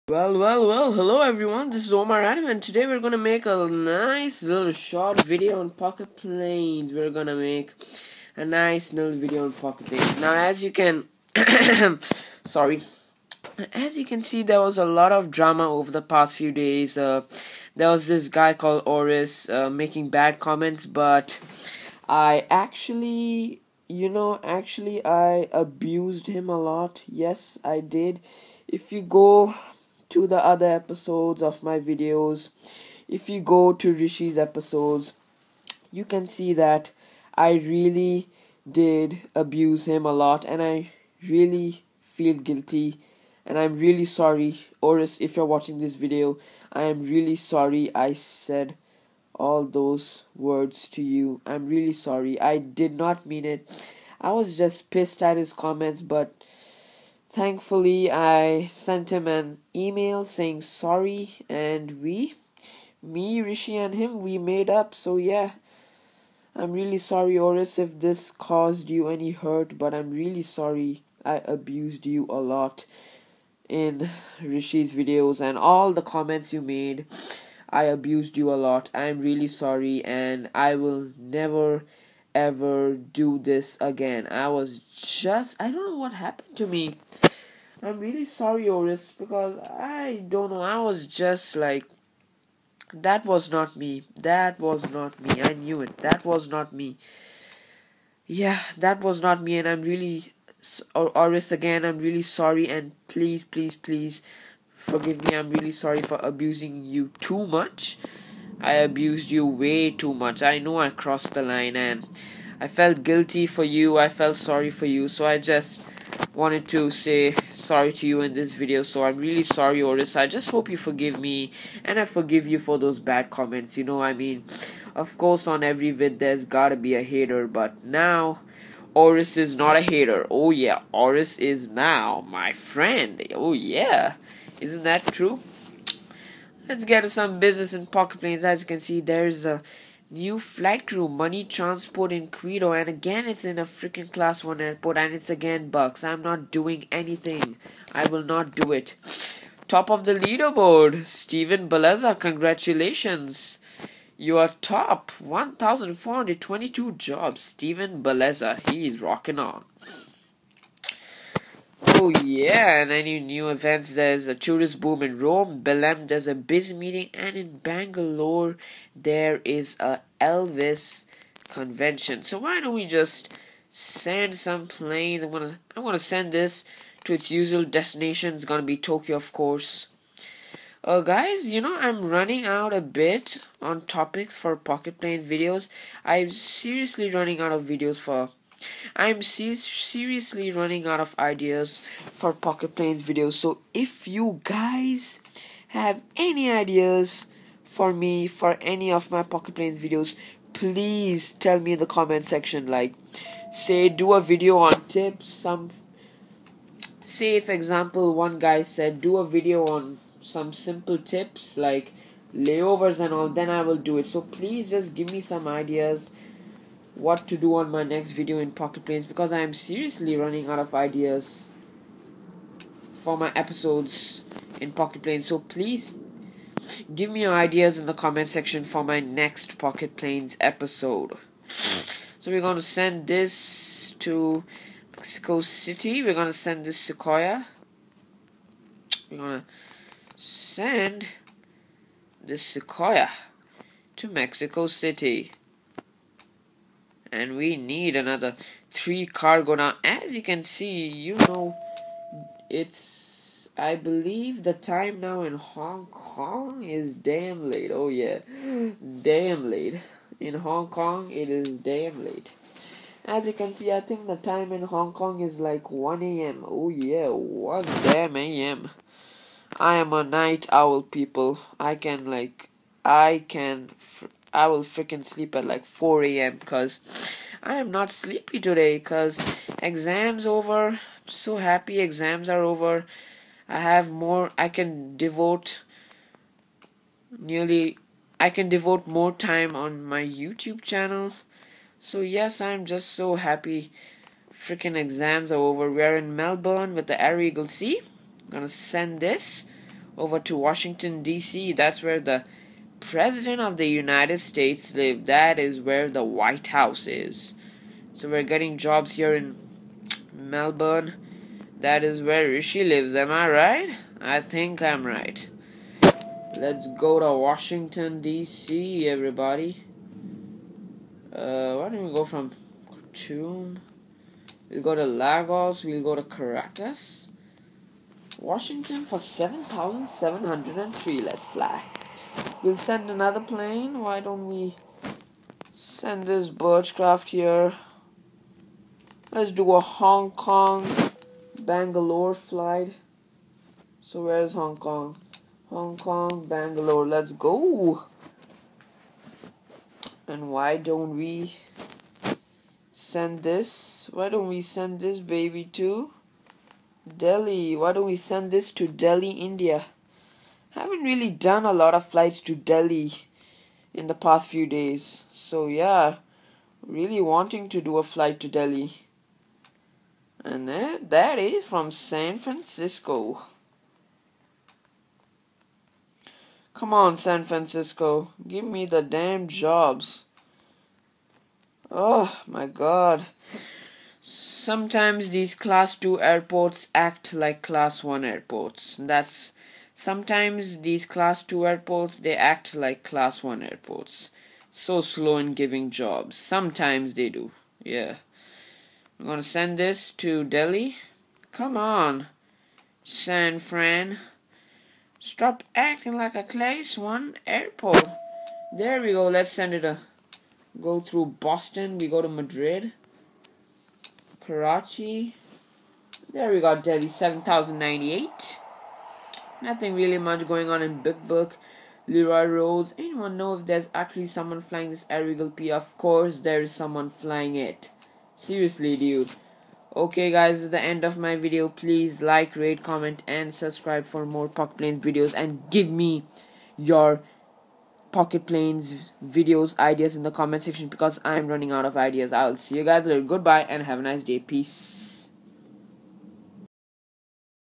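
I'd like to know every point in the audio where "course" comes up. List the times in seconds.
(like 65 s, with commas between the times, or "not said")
125 s, 179 s, 425 s.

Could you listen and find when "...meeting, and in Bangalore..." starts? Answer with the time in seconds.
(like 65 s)
166 s.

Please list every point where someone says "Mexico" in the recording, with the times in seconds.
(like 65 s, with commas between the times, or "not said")
234 s, 244 s.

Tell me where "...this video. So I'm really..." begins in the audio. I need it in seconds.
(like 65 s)
118 s.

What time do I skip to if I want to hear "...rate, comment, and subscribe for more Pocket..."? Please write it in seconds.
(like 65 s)
432 s.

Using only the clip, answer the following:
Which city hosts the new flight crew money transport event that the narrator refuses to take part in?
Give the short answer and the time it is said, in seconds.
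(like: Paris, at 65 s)
Quito, at 142 s.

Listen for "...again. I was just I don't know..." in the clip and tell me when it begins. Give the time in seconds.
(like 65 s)
83 s.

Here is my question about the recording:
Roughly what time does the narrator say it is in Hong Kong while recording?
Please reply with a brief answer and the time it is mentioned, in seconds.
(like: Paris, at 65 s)
1 a.m., at 265 s.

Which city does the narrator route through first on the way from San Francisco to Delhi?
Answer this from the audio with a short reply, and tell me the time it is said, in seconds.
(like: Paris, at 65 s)
Boston, at 411 s.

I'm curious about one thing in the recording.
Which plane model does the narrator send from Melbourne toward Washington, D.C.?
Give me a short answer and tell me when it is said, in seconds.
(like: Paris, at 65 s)
Air Eagle C, at 297 s.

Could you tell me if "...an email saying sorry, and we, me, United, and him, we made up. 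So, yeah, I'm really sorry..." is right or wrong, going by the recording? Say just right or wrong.
wrong.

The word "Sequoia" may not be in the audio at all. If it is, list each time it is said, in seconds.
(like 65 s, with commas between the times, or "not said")
236 s, 242 s.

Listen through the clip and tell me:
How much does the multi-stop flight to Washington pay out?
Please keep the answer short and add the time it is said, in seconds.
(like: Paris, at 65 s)
7,703, at 328 s.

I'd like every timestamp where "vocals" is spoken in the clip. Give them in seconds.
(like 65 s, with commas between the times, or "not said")
not said.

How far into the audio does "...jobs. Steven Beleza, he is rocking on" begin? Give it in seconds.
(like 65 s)
156 s.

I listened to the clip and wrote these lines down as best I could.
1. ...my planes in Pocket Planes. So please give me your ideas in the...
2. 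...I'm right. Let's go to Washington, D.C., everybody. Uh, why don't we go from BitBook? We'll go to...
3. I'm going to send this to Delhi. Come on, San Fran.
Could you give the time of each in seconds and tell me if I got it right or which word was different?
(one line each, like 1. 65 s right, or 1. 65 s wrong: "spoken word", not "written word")
1. 223 s wrong: "episodes", not "planes"
2. 314 s wrong: "Khartoum", not "BitBook"
3. 398 s right.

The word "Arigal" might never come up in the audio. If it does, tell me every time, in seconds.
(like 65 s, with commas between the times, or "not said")
424 s.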